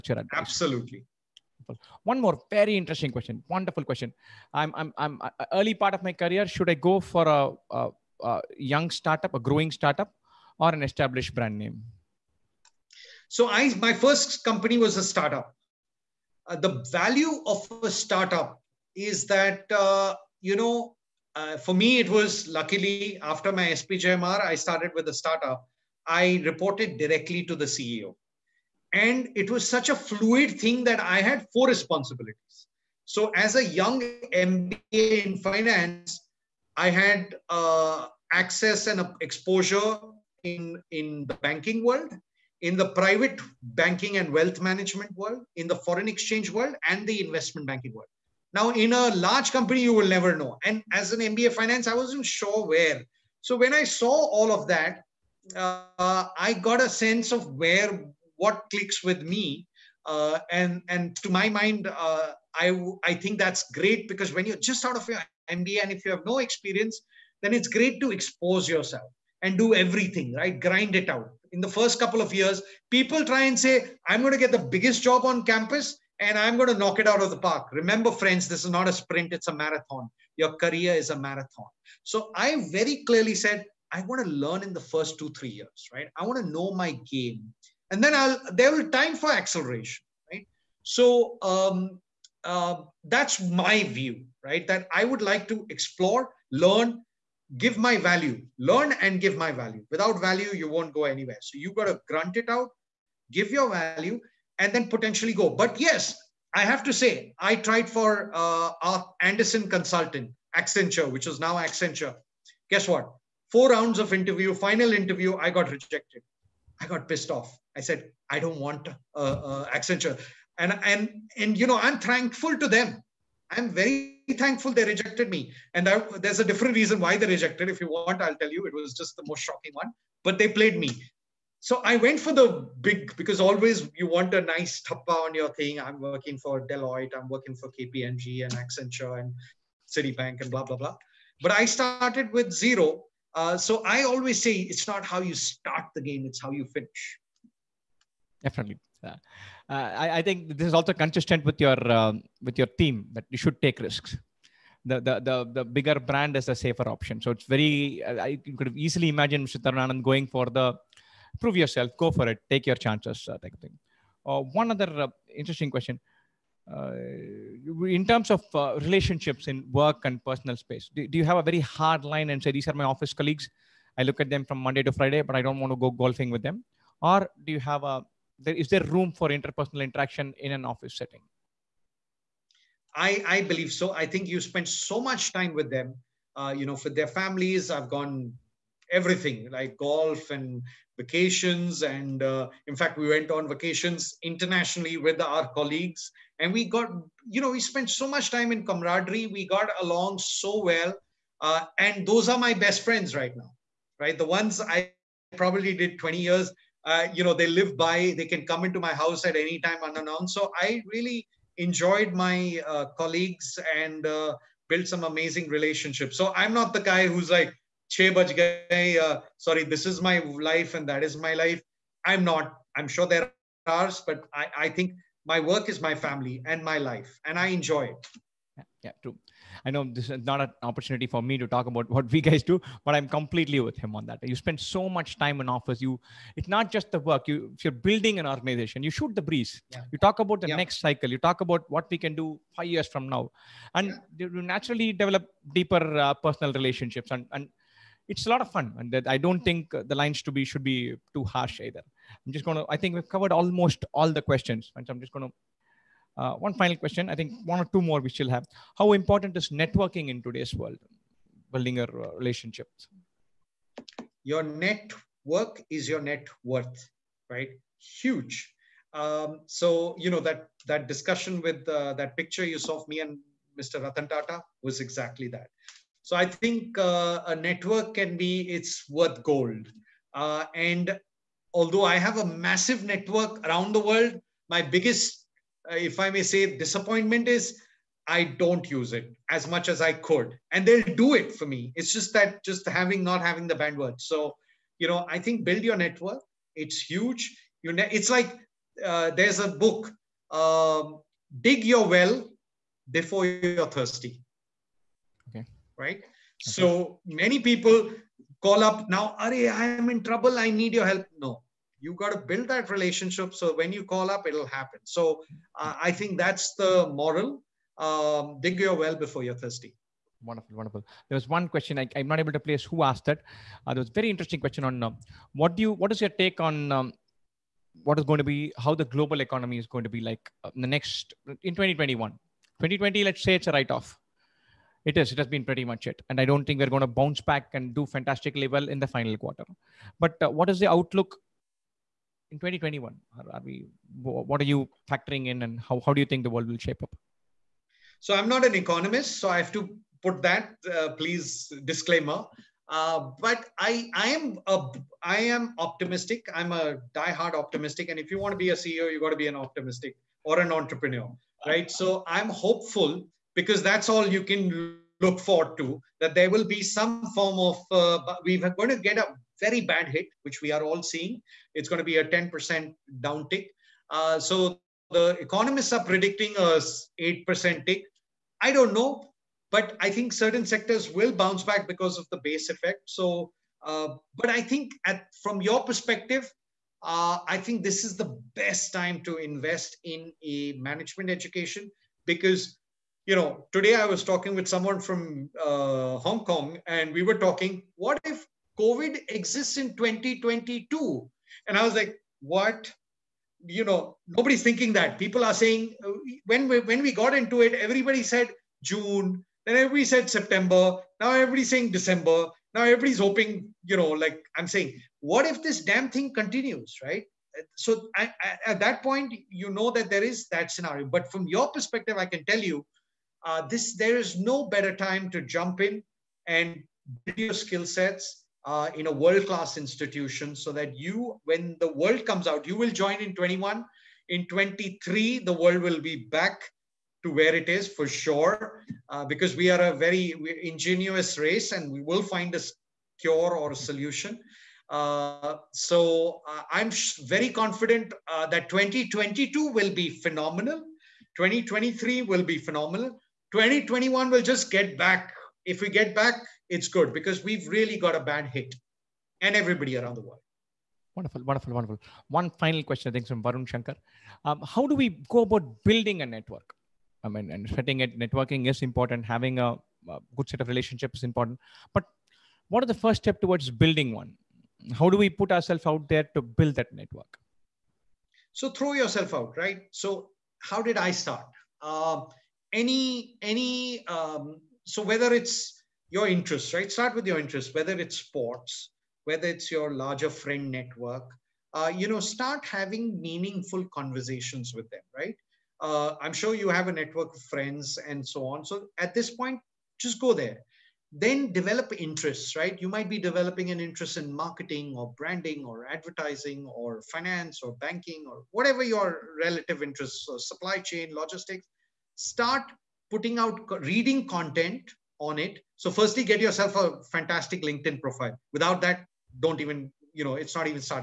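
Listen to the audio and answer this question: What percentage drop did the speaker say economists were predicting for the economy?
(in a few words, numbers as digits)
8%.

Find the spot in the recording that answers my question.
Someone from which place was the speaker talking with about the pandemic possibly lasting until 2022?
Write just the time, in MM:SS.
06:35.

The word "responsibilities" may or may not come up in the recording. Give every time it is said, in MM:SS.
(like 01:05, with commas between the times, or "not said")
00:31.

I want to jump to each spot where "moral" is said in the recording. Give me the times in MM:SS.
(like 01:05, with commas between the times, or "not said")
05:17.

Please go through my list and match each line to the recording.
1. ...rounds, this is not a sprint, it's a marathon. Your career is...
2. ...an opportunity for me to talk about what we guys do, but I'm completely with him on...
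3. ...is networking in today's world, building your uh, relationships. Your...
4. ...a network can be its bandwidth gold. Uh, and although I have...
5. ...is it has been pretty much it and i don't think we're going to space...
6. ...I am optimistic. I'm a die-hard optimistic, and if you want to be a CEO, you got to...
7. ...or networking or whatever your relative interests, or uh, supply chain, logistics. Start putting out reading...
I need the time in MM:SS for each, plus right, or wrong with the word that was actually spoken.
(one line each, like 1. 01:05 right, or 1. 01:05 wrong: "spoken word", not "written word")
1. 01:18 wrong: "friends", not "rounds"
2. 03:50 right
3. 04:19 right
4. 04:37 wrong: "worth", not "bandwidth"
5. 05:35 wrong: "bounce", not "space"
6. 05:55 right
7. 08:27 wrong: "banking", not "networking".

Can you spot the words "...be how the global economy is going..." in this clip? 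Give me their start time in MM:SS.
05:28.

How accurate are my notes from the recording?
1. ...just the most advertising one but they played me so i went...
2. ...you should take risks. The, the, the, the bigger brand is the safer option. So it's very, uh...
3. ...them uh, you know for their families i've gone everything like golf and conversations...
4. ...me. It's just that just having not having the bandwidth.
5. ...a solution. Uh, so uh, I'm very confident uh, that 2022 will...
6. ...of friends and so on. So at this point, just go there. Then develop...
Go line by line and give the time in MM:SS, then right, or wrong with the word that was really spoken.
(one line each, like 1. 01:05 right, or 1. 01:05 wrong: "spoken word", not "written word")
1. 02:08 wrong: "shocking", not "advertising"
2. 02:33 right
3. 03:05 wrong: "vacations", not "conversations"
4. 04:51 right
5. 07:23 right
6. 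08:17 right.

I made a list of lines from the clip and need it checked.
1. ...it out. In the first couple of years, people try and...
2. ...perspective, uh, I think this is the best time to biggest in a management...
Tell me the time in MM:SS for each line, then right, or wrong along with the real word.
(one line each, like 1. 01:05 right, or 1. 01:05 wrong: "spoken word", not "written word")
1. 01:10 right
2. 06:25 wrong: "invest", not "biggest".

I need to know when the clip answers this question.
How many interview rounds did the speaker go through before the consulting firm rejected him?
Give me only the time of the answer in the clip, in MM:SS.
01:53.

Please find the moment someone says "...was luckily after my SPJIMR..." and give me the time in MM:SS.
00:22.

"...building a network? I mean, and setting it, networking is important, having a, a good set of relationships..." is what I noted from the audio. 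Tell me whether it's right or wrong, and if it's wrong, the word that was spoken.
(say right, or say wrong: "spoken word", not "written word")
right.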